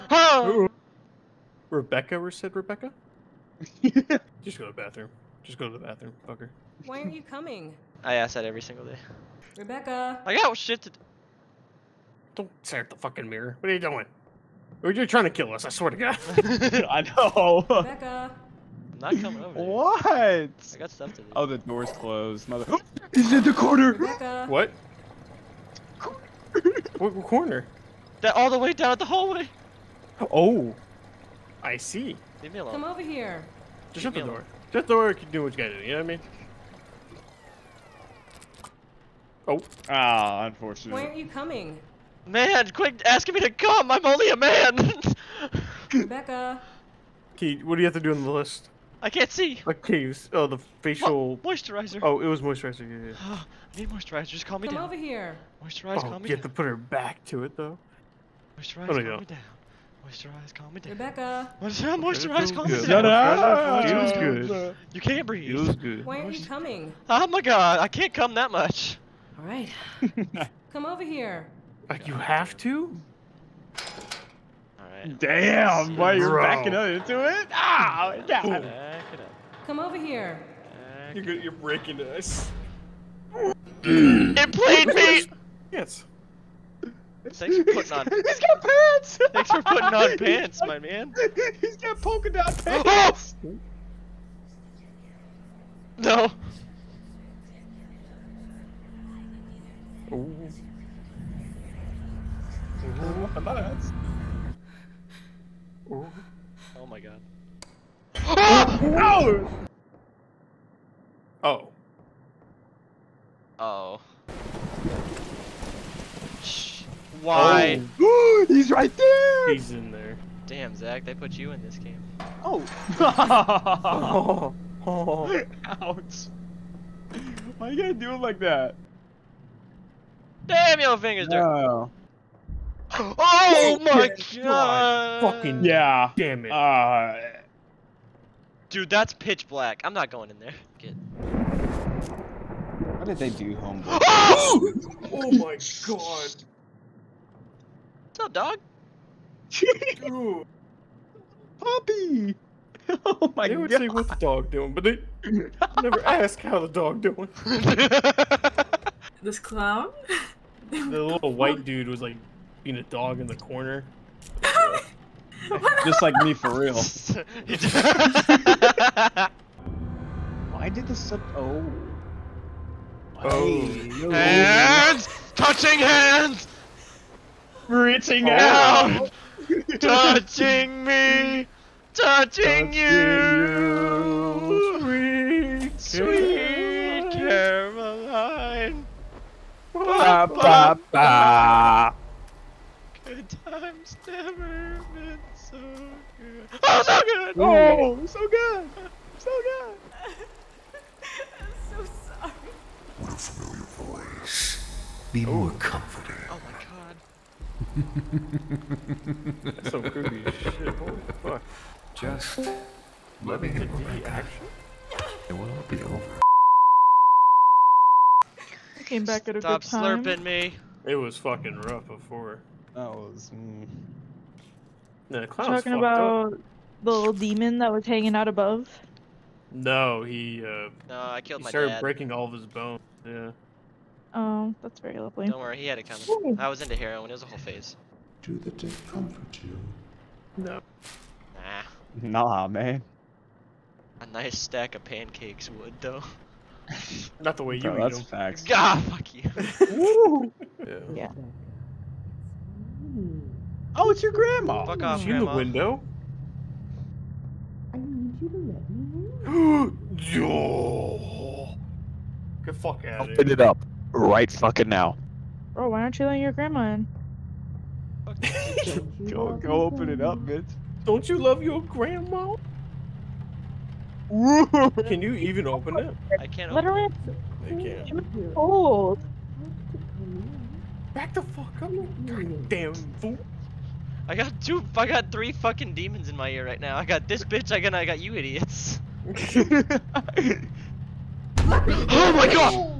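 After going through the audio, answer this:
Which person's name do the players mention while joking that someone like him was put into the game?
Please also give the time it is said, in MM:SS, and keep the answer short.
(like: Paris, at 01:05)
Zach, at 02:00.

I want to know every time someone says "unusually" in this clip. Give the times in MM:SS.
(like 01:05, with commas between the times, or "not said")
not said.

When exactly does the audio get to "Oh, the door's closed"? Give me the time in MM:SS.
00:21.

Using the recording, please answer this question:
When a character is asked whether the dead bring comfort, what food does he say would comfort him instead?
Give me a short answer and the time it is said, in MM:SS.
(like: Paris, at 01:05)
pancakes, at 04:04.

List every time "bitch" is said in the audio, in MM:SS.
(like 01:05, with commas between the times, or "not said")
04:30, 04:47.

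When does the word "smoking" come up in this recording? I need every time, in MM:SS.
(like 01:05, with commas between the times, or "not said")
not said.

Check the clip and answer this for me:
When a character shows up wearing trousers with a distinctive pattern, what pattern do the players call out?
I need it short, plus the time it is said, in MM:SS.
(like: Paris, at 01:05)
polka dot, at 01:32.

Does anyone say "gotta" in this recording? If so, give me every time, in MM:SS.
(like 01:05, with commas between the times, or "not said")
00:35, 02:07.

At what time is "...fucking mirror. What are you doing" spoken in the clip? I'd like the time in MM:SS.
00:12.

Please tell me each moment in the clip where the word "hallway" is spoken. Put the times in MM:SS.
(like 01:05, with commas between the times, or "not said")
00:29.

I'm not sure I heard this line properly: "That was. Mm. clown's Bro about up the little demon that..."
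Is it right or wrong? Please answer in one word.
wrong.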